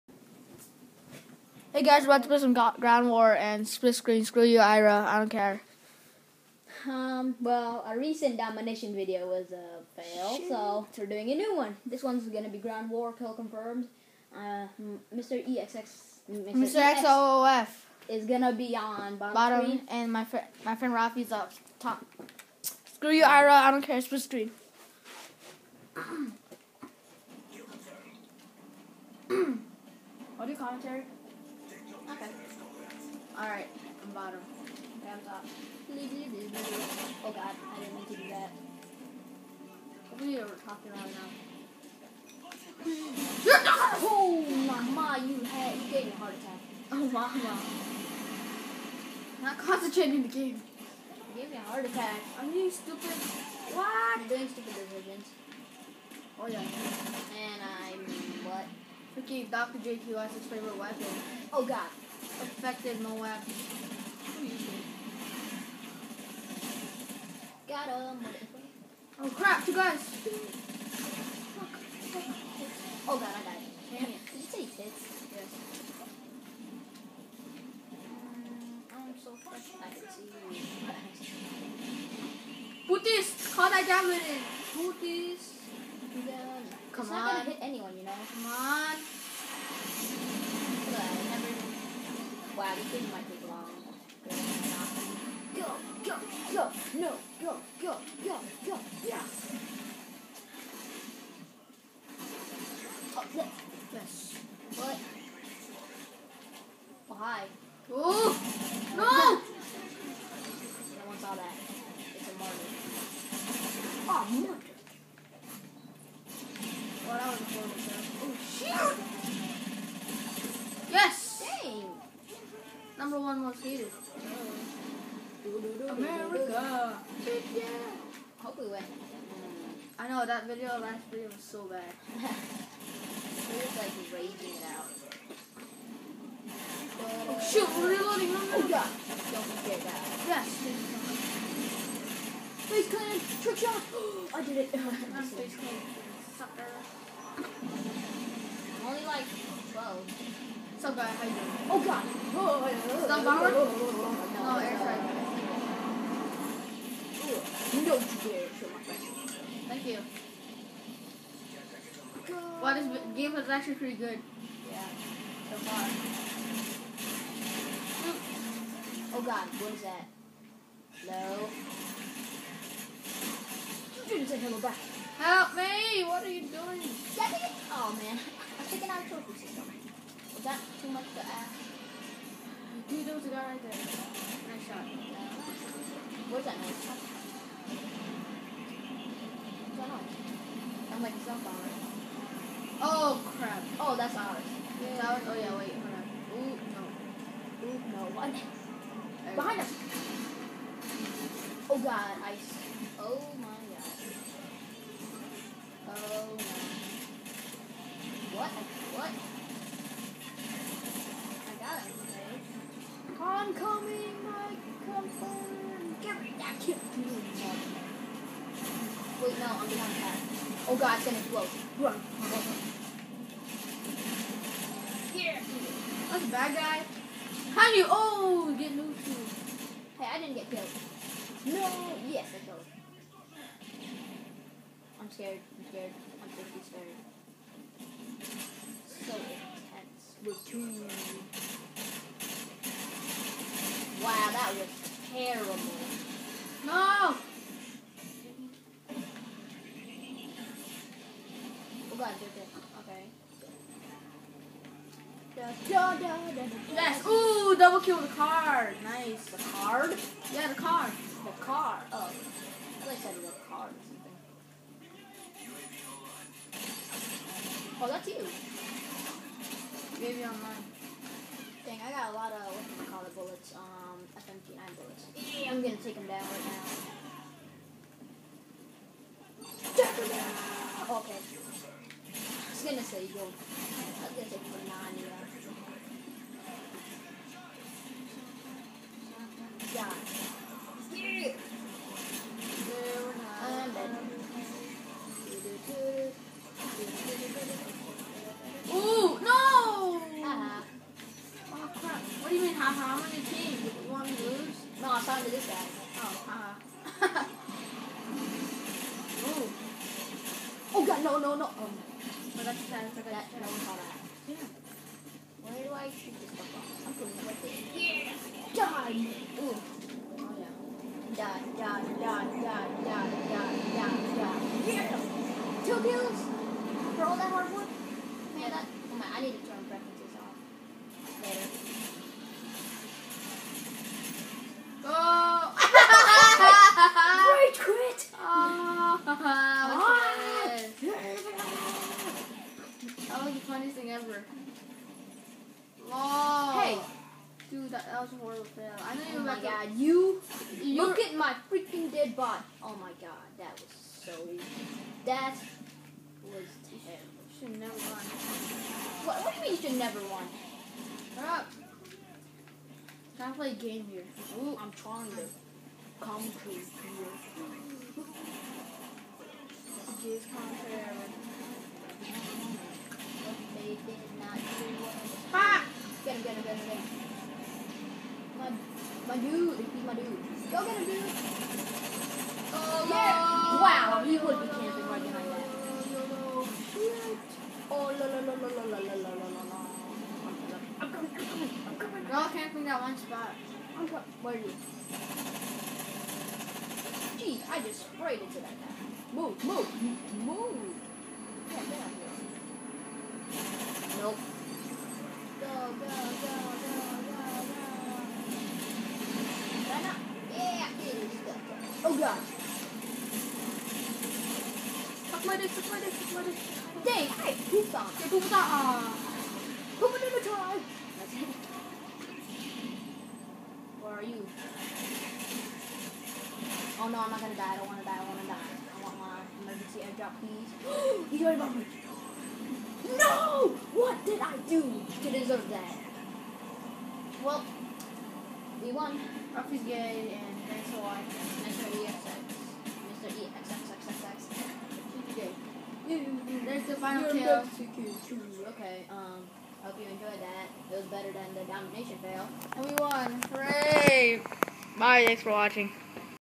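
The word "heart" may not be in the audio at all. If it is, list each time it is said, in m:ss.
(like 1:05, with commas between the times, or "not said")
0:46, 0:51.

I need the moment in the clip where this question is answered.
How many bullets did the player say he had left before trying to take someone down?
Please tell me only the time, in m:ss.
4:34.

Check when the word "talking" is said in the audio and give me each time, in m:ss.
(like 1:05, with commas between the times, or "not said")
0:40.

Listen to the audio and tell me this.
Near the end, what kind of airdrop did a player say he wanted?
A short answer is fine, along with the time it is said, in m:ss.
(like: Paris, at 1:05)
Emergency airdrop, at 7:09.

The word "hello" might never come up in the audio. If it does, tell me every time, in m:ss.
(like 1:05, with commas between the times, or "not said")
2:54.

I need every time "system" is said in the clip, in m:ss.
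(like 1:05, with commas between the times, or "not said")
2:59.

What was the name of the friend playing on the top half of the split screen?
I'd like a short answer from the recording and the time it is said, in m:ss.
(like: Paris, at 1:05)
Rafi, at 0:20.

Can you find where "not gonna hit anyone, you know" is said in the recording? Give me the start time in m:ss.
1:27.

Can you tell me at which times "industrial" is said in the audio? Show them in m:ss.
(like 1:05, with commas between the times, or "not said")
not said.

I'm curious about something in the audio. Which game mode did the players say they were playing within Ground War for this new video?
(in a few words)
Kill confirmed.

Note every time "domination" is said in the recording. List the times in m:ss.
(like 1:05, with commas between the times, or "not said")
0:08, 7:31.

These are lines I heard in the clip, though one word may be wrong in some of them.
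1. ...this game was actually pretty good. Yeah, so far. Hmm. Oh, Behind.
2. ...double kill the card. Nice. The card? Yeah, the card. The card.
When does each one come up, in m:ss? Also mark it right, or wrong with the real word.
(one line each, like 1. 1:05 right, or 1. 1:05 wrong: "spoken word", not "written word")
1. 2:42 wrong: "God", not "Behind"
2. 4:17 right.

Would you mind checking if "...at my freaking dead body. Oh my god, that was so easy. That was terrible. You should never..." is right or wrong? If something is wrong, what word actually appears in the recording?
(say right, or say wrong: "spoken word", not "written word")
right.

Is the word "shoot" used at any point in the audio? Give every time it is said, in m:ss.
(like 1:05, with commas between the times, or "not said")
2:17, 5:15.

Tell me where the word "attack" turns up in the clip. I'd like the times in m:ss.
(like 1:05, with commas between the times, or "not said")
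0:46, 0:51.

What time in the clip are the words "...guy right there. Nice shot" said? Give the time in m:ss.
3:03.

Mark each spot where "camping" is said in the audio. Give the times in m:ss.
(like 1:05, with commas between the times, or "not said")
6:24, 6:32.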